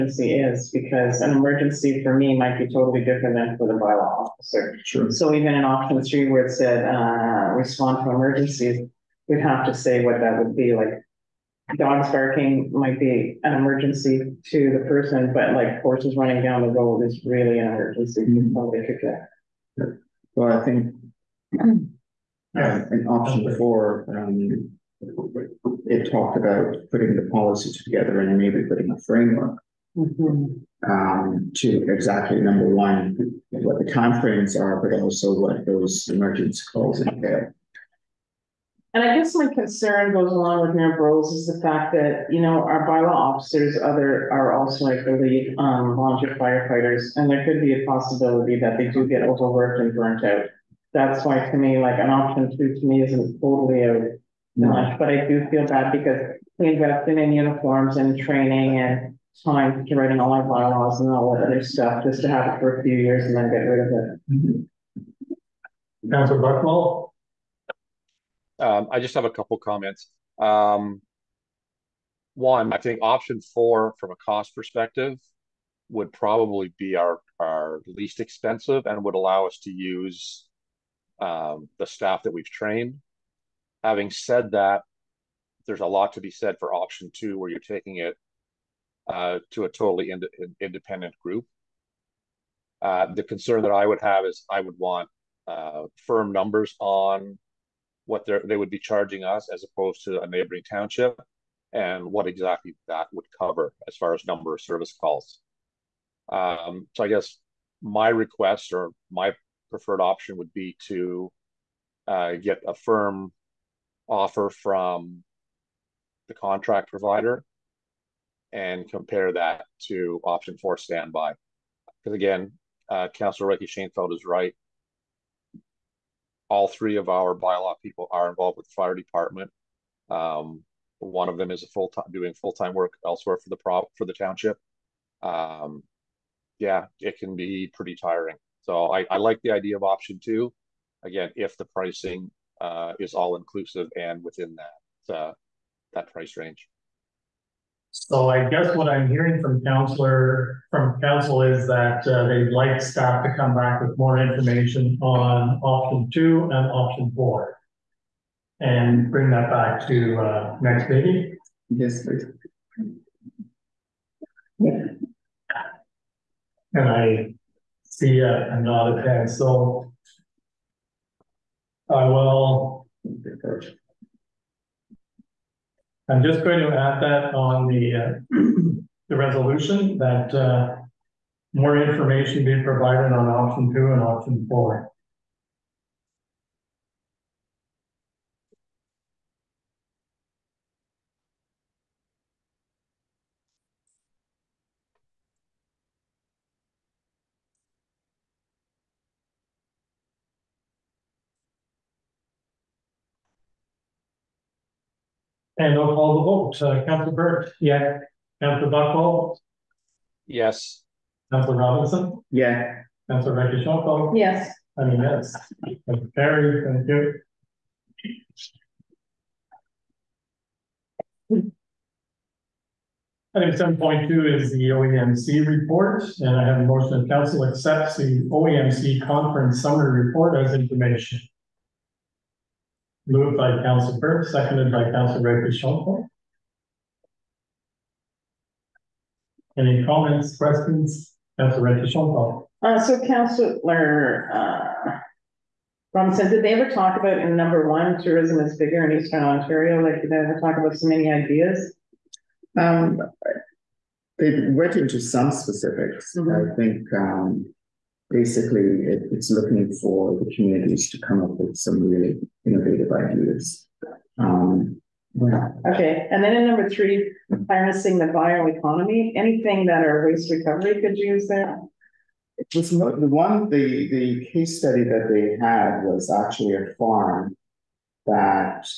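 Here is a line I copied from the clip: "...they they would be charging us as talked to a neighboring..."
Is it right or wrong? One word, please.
wrong.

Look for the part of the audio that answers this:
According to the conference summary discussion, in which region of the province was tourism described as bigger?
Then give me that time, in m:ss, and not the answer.
4:09.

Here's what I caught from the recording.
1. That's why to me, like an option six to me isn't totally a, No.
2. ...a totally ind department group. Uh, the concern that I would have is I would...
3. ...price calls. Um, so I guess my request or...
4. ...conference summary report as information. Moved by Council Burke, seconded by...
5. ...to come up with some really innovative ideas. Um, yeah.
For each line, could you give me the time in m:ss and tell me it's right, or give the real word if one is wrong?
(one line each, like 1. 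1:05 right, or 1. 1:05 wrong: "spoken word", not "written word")
1. 0:50 wrong: "two", not "six"
2. 1:29 wrong: "independent", not "department"
3. 1:44 wrong: "service", not "price"
4. 3:49 right
5. 4:20 right.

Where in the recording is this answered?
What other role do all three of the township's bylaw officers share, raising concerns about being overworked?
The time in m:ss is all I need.
2:08.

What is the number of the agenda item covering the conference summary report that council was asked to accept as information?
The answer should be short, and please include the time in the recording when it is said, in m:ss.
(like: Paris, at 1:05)
7.2, at 3:43.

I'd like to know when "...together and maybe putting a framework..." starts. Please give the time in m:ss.
0:27.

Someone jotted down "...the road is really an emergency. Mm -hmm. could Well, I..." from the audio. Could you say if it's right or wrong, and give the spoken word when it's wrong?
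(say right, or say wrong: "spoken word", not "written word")
right.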